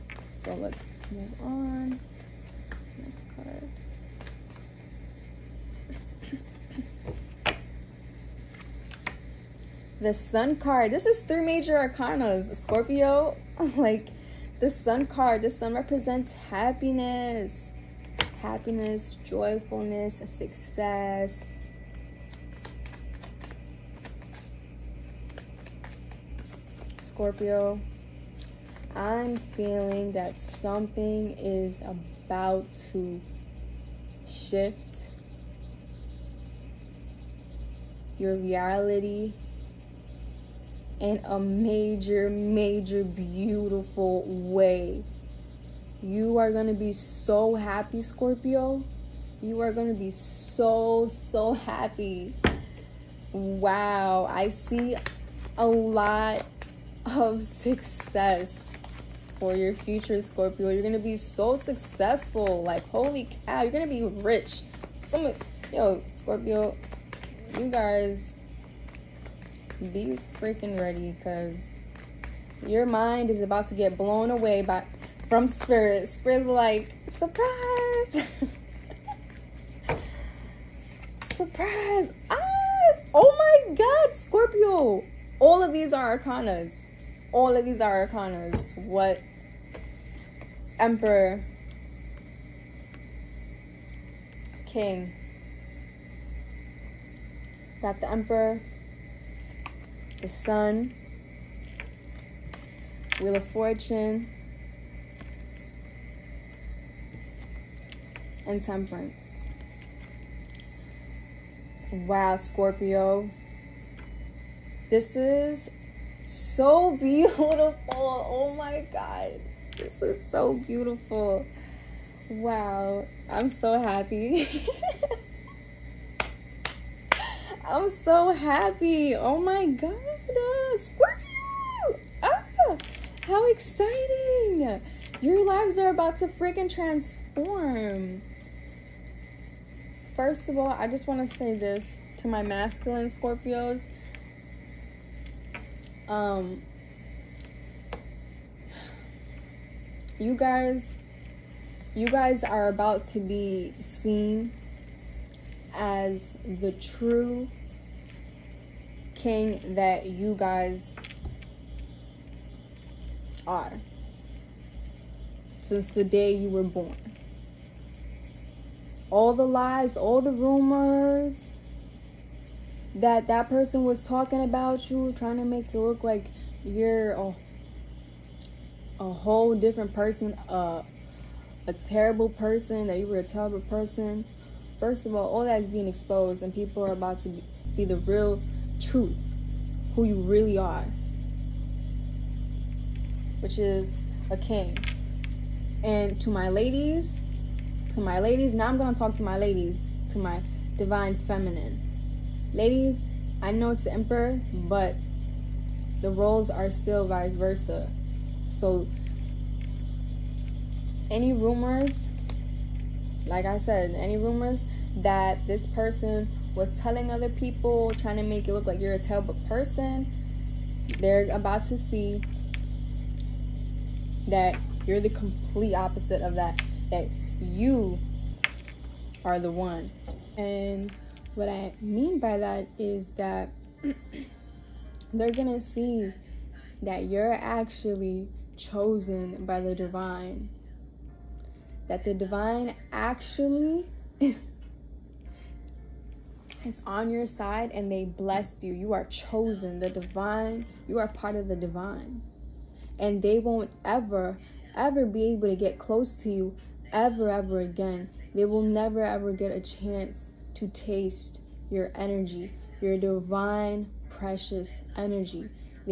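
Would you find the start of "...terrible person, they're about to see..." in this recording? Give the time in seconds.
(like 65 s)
218 s.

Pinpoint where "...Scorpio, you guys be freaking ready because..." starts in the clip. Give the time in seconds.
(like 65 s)
66 s.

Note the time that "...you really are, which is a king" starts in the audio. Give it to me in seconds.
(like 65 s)
190 s.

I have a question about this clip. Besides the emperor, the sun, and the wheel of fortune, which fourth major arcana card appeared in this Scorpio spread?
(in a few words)
Temperance.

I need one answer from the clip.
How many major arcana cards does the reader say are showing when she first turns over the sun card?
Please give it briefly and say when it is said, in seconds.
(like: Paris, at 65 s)
3, at 11 s.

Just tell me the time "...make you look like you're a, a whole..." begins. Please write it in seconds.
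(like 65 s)
175 s.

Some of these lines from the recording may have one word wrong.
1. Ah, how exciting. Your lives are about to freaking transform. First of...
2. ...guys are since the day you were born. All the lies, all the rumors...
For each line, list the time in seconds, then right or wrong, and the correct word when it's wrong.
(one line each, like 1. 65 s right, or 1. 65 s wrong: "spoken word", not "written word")
1. 132 s right
2. 160 s right.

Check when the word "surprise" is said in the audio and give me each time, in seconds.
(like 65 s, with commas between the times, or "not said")
77 s, 81 s.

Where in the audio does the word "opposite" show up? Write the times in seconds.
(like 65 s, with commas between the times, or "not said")
225 s.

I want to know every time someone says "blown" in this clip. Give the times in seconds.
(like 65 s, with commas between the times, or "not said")
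73 s.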